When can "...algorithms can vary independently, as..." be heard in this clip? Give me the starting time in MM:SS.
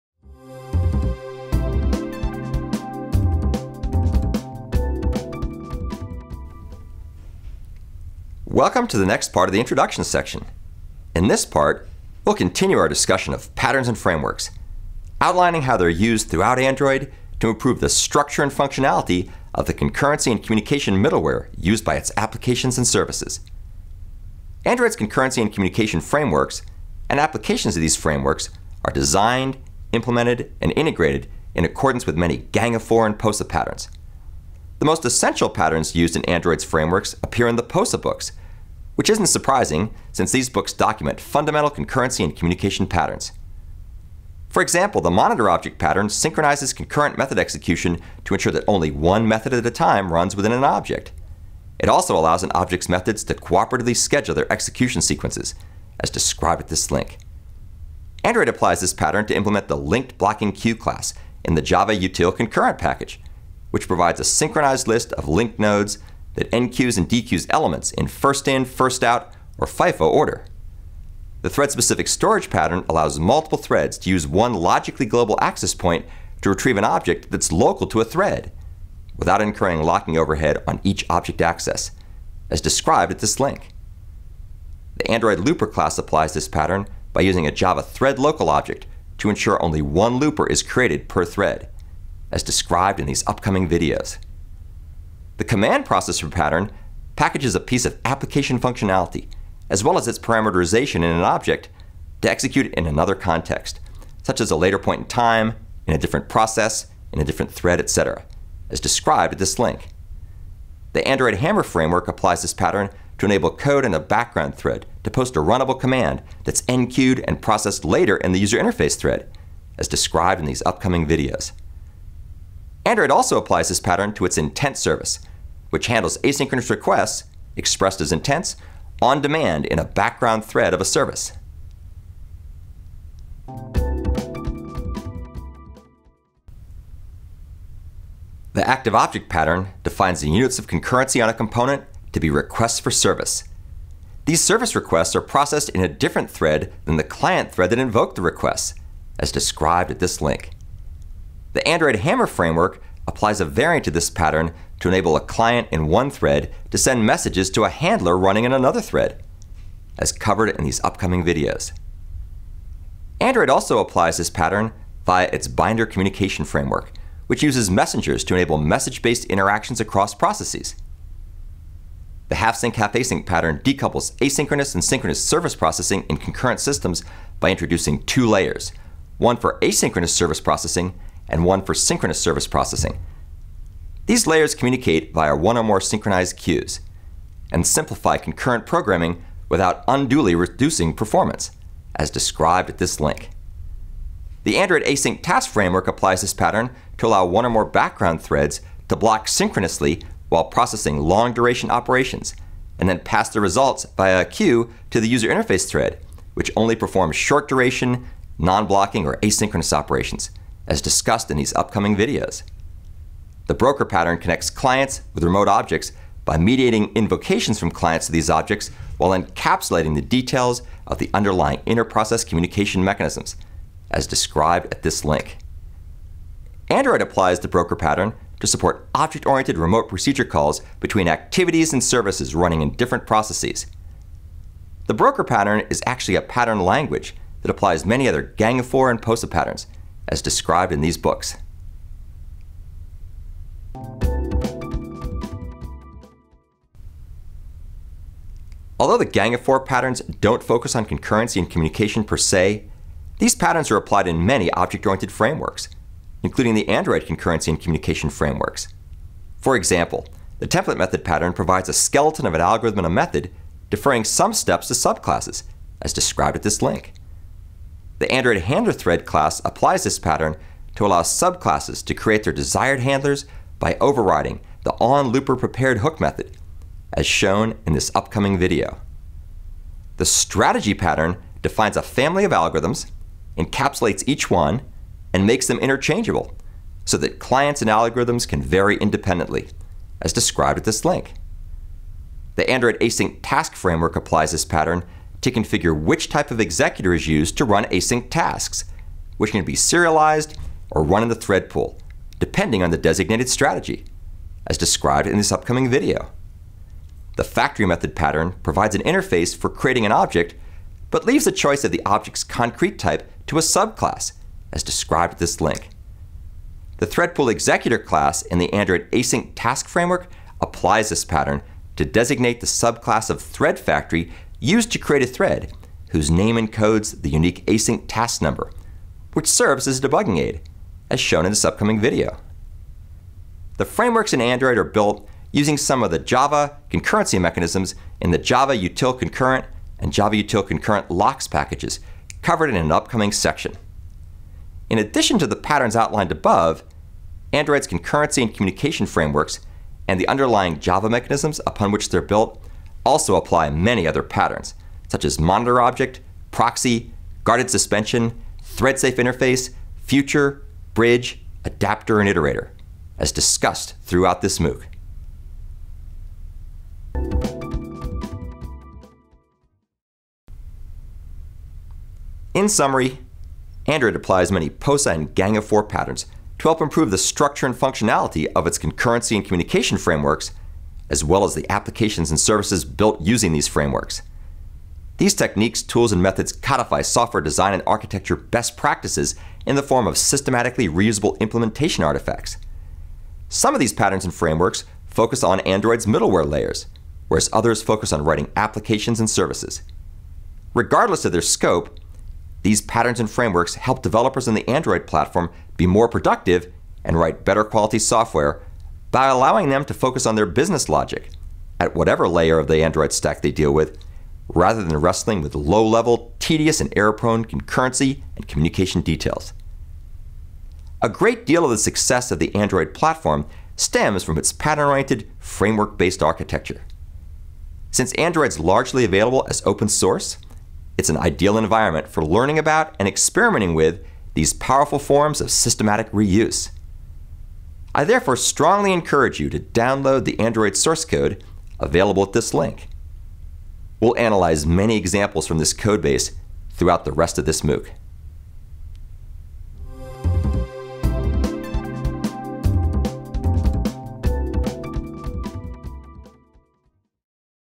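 04:47.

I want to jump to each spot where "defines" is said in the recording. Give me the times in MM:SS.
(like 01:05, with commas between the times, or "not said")
02:19, 04:41.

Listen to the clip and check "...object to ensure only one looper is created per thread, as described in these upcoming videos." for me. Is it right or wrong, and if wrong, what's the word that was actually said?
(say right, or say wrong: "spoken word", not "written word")
right.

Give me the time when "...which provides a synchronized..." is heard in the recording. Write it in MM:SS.
01:03.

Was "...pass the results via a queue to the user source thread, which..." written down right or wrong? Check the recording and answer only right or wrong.
wrong.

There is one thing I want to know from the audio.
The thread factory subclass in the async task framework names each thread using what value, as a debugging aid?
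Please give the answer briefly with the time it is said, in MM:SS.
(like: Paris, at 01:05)
unique async task number, at 05:27.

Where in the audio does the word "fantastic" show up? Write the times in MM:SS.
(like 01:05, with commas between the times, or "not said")
not said.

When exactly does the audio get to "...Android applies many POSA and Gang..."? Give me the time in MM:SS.
06:13.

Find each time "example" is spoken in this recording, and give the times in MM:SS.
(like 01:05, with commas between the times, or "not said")
00:44, 04:19, 07:24.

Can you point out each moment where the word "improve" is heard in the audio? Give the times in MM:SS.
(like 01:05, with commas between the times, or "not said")
00:17, 06:16.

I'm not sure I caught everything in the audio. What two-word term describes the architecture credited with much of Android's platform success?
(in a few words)
pattern oriented.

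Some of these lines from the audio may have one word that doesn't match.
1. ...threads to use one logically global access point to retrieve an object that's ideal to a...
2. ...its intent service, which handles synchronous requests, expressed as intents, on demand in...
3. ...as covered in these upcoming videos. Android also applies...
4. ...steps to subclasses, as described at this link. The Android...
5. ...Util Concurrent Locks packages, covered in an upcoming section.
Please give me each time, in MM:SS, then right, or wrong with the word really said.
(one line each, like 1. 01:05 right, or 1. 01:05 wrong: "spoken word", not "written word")
1. 01:13 wrong: "local", not "ideal"
2. 02:04 wrong: "asynchronous", not "synchronous"
3. 02:39 right
4. 04:24 right
5. 05:40 right.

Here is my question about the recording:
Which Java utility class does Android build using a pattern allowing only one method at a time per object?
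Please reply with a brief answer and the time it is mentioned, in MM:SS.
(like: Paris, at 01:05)
linked blocking queue, at 00:59.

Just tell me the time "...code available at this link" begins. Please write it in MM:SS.
07:20.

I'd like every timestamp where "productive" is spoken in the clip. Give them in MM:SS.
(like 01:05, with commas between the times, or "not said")
06:45.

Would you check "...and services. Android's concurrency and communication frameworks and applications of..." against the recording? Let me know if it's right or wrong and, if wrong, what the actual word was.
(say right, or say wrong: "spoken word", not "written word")
right.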